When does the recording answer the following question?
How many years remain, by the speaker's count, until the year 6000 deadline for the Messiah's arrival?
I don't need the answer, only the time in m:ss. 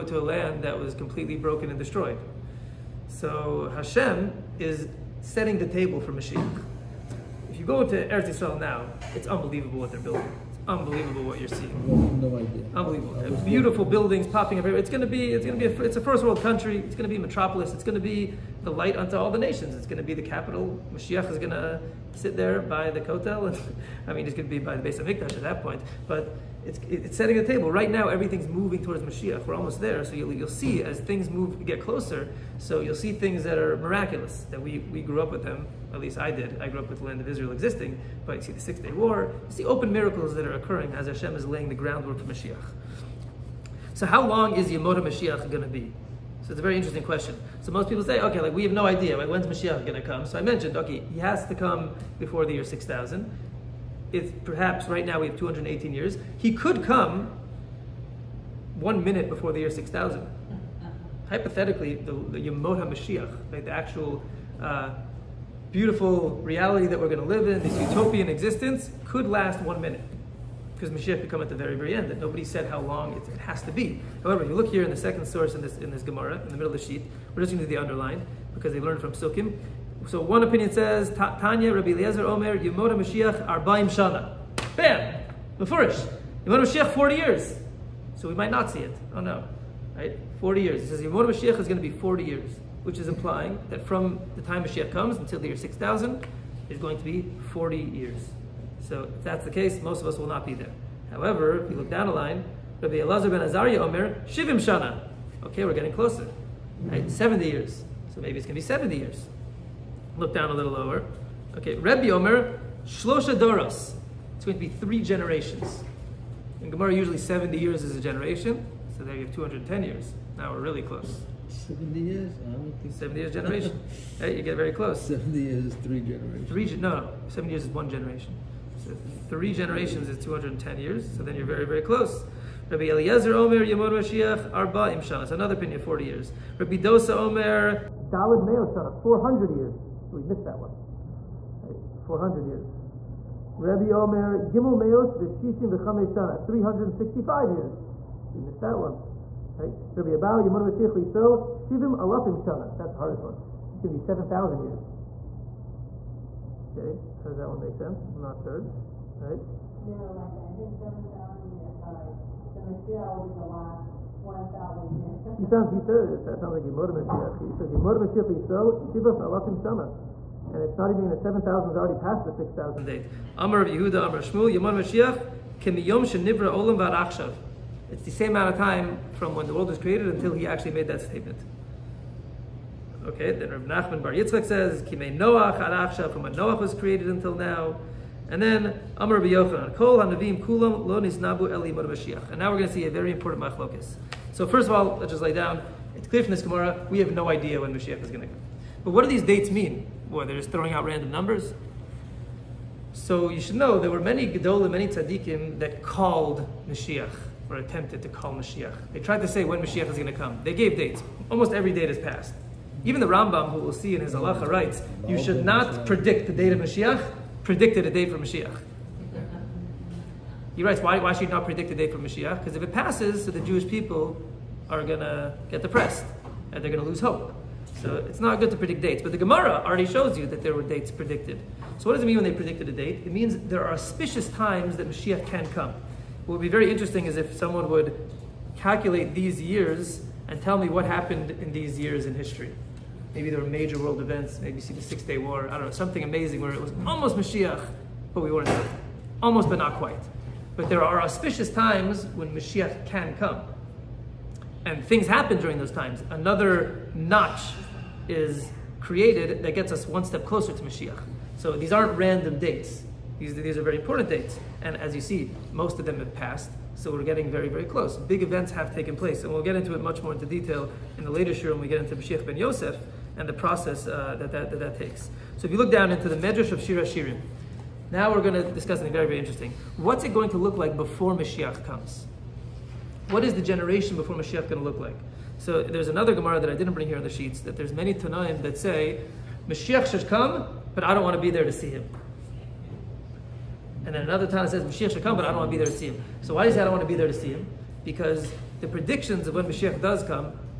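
0:55.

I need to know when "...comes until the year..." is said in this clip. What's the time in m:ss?
1:34.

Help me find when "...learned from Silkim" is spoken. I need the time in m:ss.
1:18.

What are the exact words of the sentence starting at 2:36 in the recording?
Okay, how does that one make sense?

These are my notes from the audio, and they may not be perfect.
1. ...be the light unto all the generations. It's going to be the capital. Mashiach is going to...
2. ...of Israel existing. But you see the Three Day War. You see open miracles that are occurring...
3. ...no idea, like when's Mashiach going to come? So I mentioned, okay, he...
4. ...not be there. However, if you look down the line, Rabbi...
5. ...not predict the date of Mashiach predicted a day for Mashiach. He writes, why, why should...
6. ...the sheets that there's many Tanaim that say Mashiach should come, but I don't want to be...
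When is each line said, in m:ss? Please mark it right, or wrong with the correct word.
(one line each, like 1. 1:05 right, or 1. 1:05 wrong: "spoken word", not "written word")
1. 0:18 wrong: "nations", not "generations"
2. 0:37 wrong: "Six", not "Three"
3. 0:48 right
4. 1:40 right
5. 3:35 right
6. 4:47 right.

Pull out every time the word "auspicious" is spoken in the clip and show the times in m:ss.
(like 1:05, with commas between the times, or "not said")
3:53, 4:11.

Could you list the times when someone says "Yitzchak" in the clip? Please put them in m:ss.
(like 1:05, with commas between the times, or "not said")
3:04.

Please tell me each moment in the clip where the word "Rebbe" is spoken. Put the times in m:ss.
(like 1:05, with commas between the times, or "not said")
1:51.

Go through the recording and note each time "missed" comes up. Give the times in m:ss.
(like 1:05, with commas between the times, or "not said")
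2:20, 2:28.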